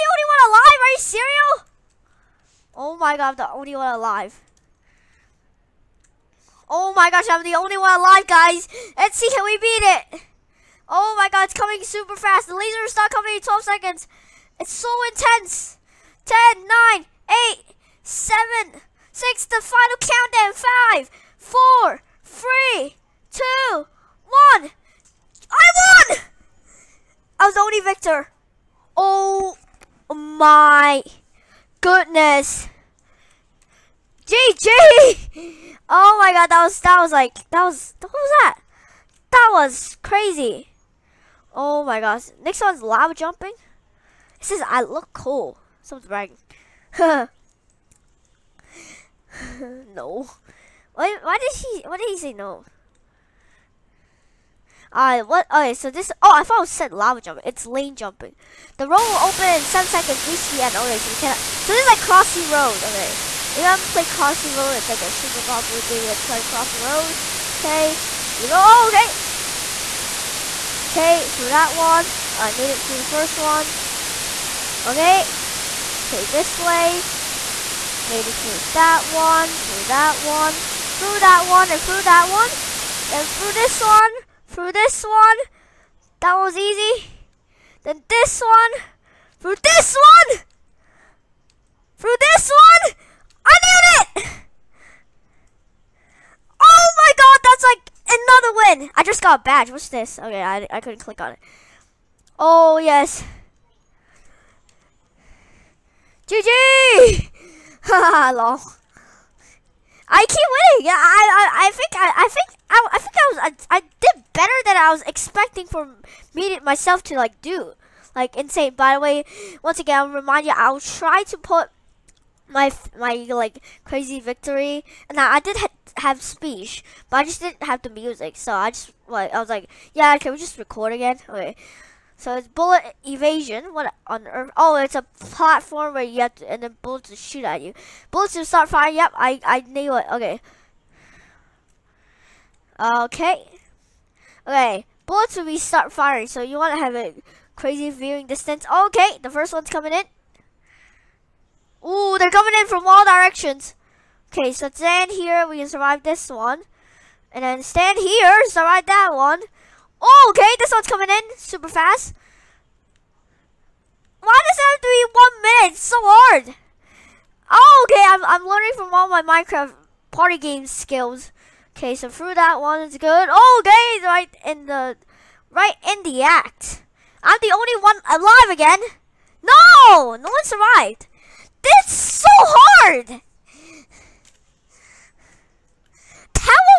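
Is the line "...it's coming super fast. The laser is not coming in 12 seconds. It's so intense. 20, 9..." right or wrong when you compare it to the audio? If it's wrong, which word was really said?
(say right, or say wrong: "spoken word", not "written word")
wrong: "10", not "20".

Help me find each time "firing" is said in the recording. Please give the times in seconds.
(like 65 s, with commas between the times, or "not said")
138 s, 145 s.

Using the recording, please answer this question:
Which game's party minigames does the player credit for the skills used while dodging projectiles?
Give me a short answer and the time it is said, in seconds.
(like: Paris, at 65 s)
Minecraft, at 169 s.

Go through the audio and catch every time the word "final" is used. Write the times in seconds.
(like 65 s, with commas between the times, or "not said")
19 s.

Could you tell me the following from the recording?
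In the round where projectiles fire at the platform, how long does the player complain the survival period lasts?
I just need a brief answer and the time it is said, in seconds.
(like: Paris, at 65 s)
1 minute, at 165 s.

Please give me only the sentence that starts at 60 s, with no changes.
Okay, so we cannot so this is like Crossy Road, okay.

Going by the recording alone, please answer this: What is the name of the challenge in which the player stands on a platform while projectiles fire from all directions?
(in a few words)
bullet evasion.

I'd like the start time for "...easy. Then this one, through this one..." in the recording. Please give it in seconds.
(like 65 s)
86 s.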